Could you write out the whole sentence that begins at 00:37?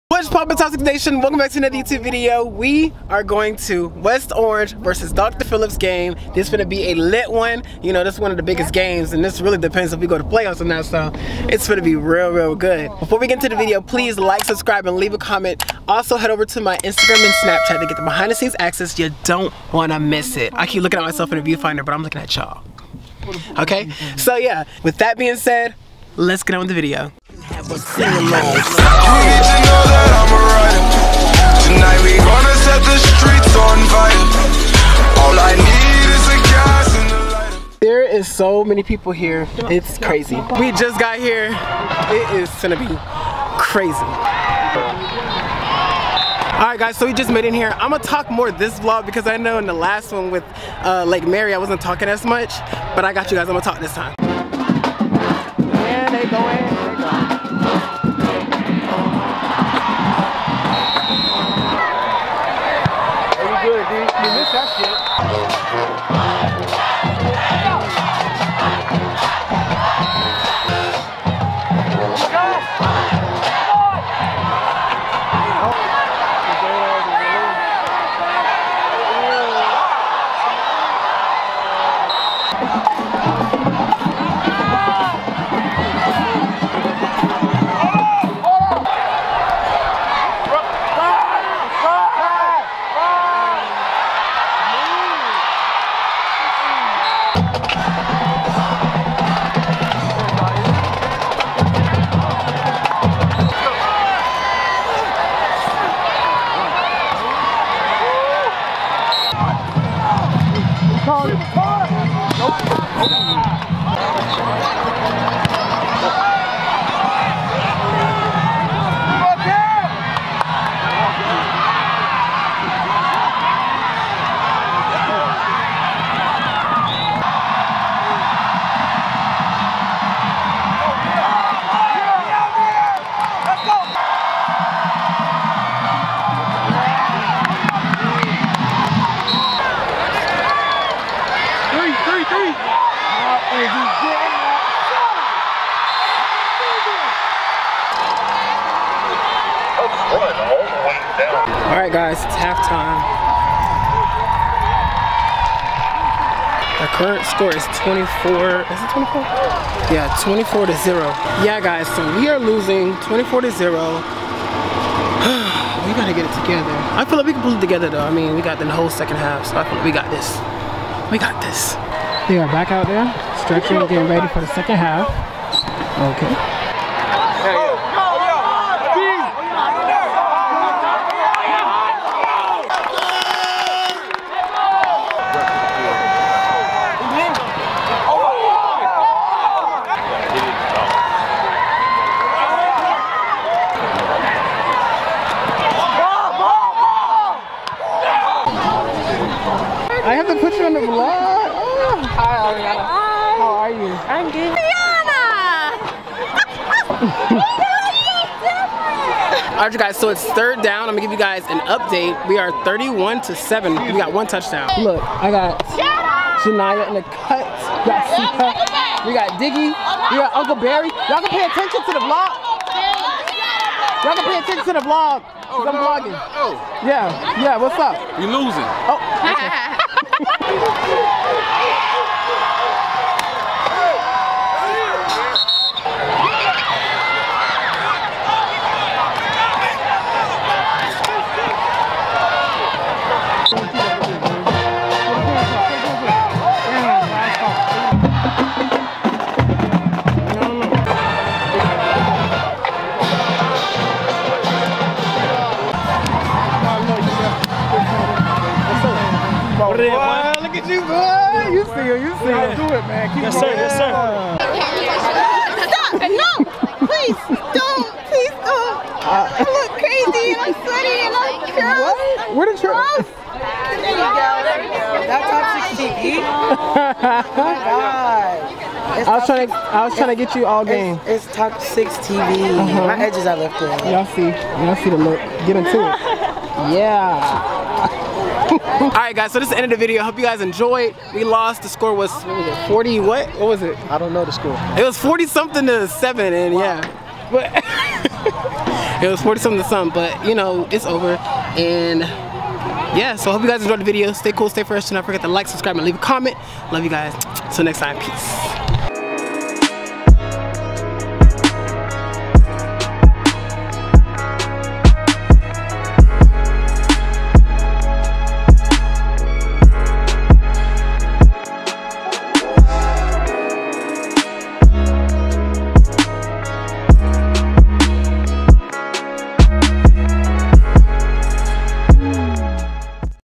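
There is so many people here.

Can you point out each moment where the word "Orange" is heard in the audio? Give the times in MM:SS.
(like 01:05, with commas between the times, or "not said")
00:00, 00:04.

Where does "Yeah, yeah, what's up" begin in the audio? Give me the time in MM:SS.
03:46.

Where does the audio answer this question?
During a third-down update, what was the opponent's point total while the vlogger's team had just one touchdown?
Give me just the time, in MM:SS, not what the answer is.
03:32.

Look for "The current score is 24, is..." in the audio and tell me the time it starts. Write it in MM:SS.
02:36.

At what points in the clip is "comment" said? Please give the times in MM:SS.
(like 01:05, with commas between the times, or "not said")
00:15, 05:05.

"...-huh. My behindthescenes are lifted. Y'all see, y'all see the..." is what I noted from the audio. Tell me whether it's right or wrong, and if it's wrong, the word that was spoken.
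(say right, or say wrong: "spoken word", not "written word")
wrong: "edges", not "behindthescenes".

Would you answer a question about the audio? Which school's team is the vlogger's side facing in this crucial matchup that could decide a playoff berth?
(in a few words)
Dr. Phillips.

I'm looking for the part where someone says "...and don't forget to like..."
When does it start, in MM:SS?
05:04.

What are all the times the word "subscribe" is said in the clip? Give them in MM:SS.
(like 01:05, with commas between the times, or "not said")
00:14, 05:05.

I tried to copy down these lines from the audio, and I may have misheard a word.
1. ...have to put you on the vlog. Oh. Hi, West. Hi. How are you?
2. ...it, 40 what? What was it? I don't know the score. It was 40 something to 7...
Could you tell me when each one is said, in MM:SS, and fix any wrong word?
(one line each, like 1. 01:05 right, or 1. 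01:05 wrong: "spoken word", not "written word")
1. 03:20 wrong: "Ariana", not "West"
2. 04:52 right.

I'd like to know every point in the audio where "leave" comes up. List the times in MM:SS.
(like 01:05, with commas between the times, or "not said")
00:14, 05:05.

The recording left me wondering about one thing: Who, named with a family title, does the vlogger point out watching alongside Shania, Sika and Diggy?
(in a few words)
Uncle Barry.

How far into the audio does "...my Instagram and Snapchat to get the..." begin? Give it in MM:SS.
00:16.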